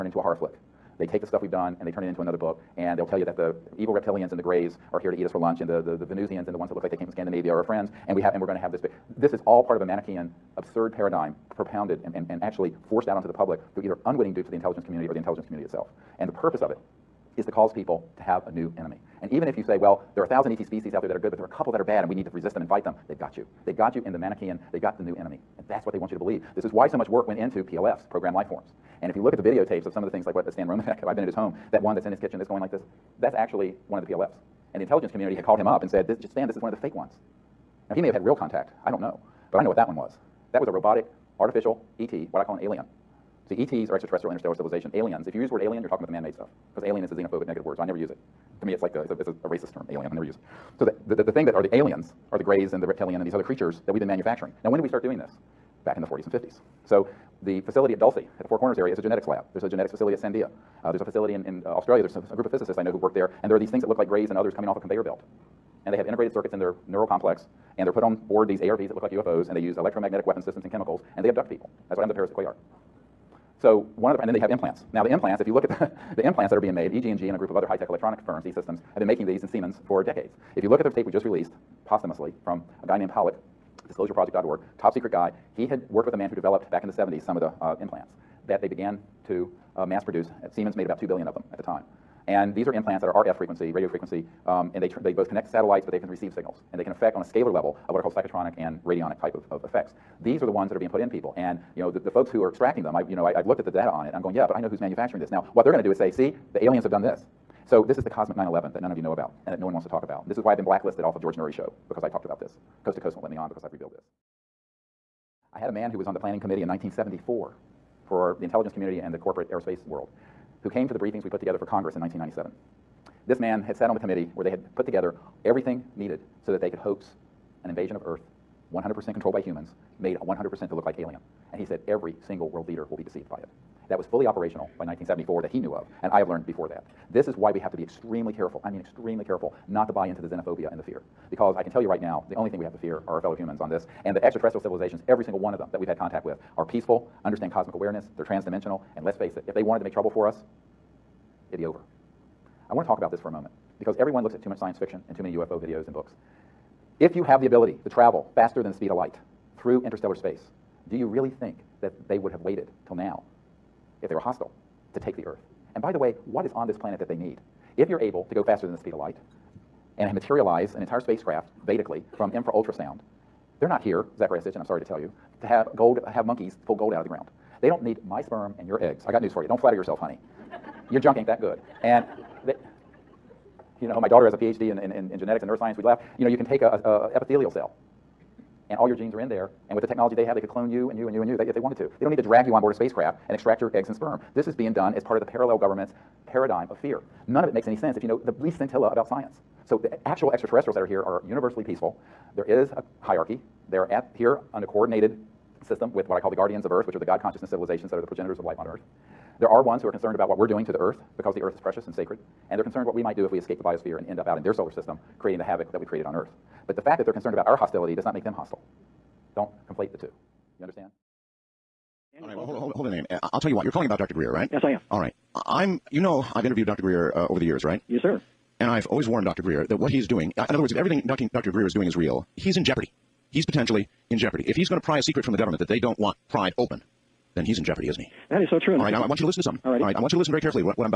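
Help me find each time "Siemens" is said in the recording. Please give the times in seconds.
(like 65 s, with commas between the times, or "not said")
79 s, 90 s.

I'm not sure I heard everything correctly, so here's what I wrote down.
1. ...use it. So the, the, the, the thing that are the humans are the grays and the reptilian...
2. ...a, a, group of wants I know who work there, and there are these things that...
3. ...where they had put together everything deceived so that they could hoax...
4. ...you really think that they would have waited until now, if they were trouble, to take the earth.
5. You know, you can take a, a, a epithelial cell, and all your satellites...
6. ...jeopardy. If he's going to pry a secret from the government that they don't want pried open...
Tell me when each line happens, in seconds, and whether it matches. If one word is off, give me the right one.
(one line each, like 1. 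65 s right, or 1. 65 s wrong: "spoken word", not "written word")
1. 50 s wrong: "aliens", not "humans"
2. 62 s wrong: "physicists", not "wants"
3. 124 s wrong: "needed", not "deceived"
4. 160 s wrong: "hostile", not "trouble"
5. 186 s wrong: "genes", not "satellites"
6. 234 s right.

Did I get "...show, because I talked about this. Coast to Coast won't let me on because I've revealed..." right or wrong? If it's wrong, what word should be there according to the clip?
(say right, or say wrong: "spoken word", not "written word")
right.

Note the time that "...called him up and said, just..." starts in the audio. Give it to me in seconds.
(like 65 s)
35 s.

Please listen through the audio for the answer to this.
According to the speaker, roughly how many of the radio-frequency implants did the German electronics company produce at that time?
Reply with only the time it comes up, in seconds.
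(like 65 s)
91 s.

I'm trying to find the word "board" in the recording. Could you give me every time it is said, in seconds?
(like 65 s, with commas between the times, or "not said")
68 s, 192 s.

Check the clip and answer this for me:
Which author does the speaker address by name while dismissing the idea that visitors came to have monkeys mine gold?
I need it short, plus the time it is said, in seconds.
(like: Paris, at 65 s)
Zacharias Sitchin, at 174 s.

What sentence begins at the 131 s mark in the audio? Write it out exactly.
And he said, every single world leader will be deceived by it.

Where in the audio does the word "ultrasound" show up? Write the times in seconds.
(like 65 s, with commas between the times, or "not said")
172 s.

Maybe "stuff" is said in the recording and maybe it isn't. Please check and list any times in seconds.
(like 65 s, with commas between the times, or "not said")
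1 s, 46 s.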